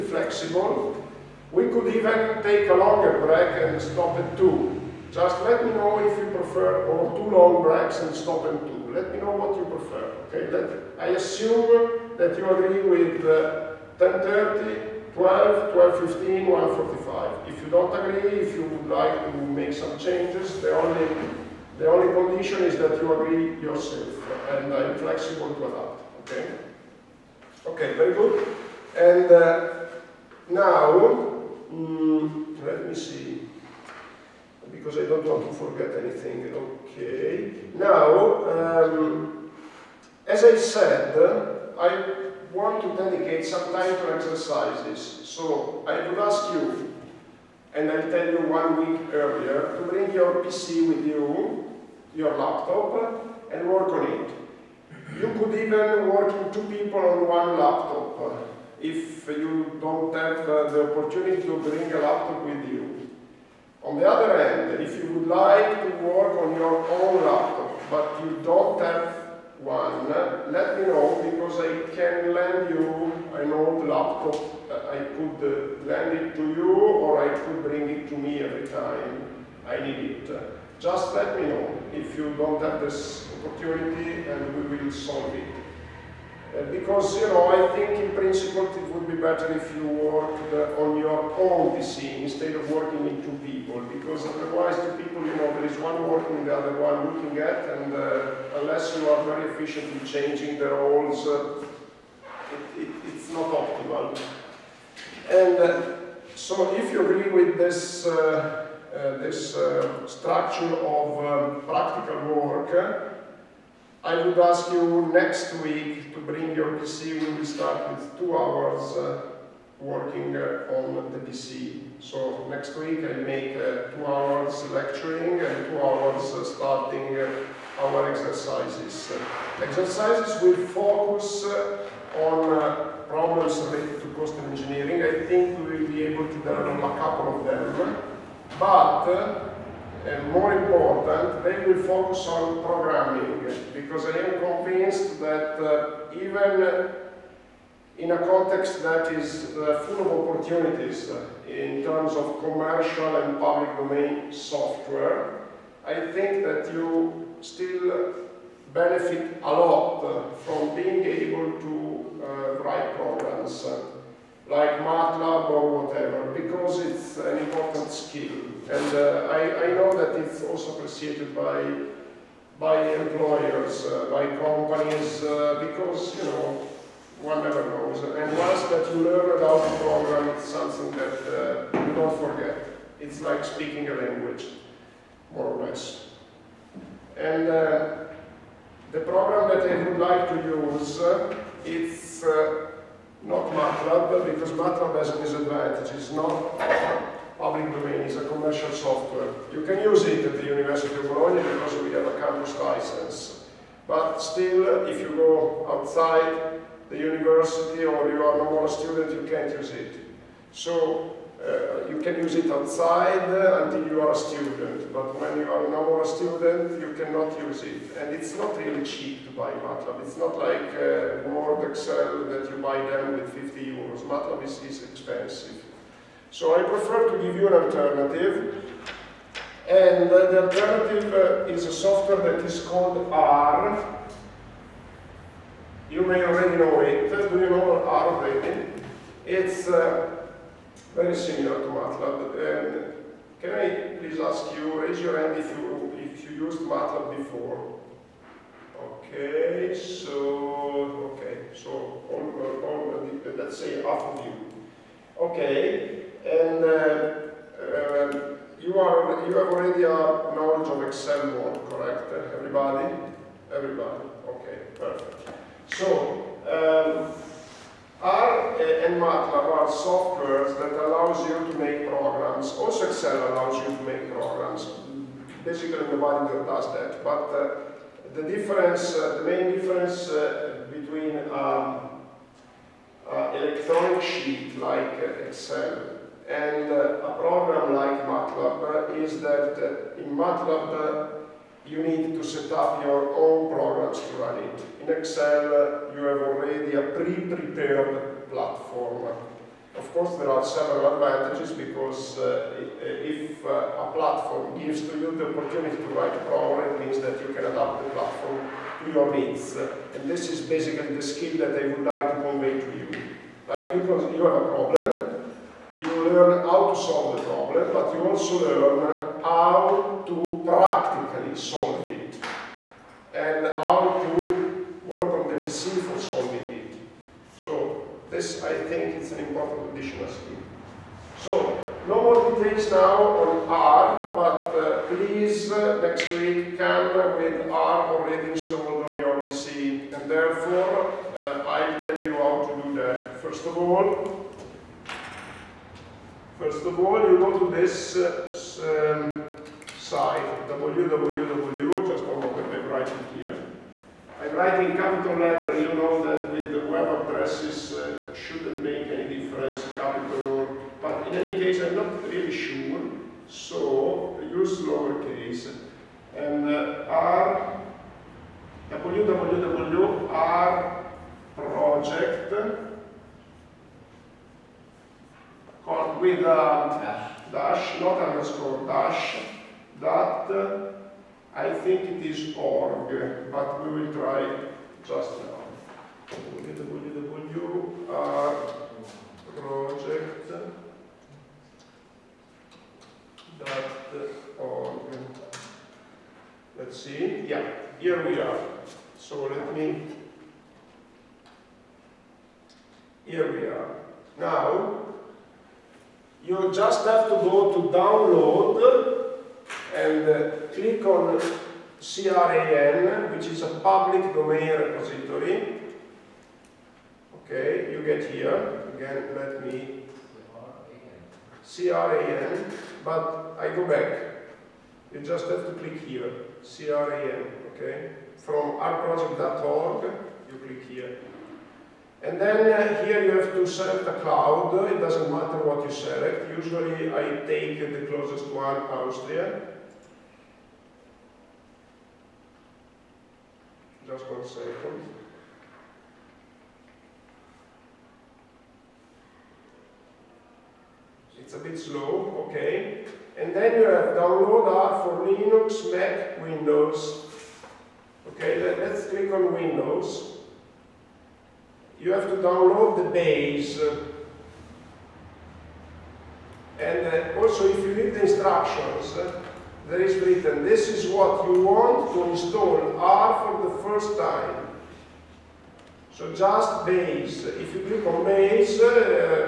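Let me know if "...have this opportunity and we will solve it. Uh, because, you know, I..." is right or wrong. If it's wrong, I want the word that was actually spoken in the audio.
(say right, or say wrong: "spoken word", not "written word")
right.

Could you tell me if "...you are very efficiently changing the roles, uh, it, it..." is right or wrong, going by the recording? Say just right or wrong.
right.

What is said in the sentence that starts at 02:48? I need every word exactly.
And uh, I, I, know that it's also appreciated by, by employers, uh, by companies, uh, because, you know, one never knows.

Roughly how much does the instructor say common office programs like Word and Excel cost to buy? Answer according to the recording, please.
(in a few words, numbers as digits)
50 euros.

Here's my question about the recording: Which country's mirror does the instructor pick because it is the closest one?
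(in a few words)
Austria.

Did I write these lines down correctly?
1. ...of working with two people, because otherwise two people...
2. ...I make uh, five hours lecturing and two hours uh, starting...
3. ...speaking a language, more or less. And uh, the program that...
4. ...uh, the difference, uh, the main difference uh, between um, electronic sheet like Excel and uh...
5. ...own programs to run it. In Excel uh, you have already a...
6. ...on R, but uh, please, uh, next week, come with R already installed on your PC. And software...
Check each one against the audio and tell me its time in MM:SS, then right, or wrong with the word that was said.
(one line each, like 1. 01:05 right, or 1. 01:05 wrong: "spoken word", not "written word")
1. 01:32 right
2. 02:02 wrong: "two", not "five"
3. 03:03 right
4. 04:37 right
5. 04:53 right
6. 05:33 wrong: "therefore", not "software".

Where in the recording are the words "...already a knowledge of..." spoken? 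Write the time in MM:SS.
04:19.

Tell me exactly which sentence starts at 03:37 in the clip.
And it's not really cheap to buy MATLAB.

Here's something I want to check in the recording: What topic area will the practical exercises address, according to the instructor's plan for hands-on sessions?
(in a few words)
cost engineering.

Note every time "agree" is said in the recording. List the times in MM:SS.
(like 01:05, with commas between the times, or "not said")
00:12, 00:17, 00:23, 01:47.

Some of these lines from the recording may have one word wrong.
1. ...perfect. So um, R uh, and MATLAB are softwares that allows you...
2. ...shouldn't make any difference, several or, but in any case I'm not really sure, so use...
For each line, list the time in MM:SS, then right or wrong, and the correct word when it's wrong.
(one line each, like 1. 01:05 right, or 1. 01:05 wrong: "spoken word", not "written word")
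1. 04:24 right
2. 05:58 wrong: "capital", not "several".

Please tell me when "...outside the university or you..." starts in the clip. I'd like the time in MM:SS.
03:25.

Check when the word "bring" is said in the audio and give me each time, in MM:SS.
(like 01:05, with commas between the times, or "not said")
00:49, 01:01, 01:17, 01:56.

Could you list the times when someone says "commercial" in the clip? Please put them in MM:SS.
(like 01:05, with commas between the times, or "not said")
02:32, 03:18.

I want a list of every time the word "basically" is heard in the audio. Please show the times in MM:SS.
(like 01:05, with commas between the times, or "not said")
04:35, 05:10.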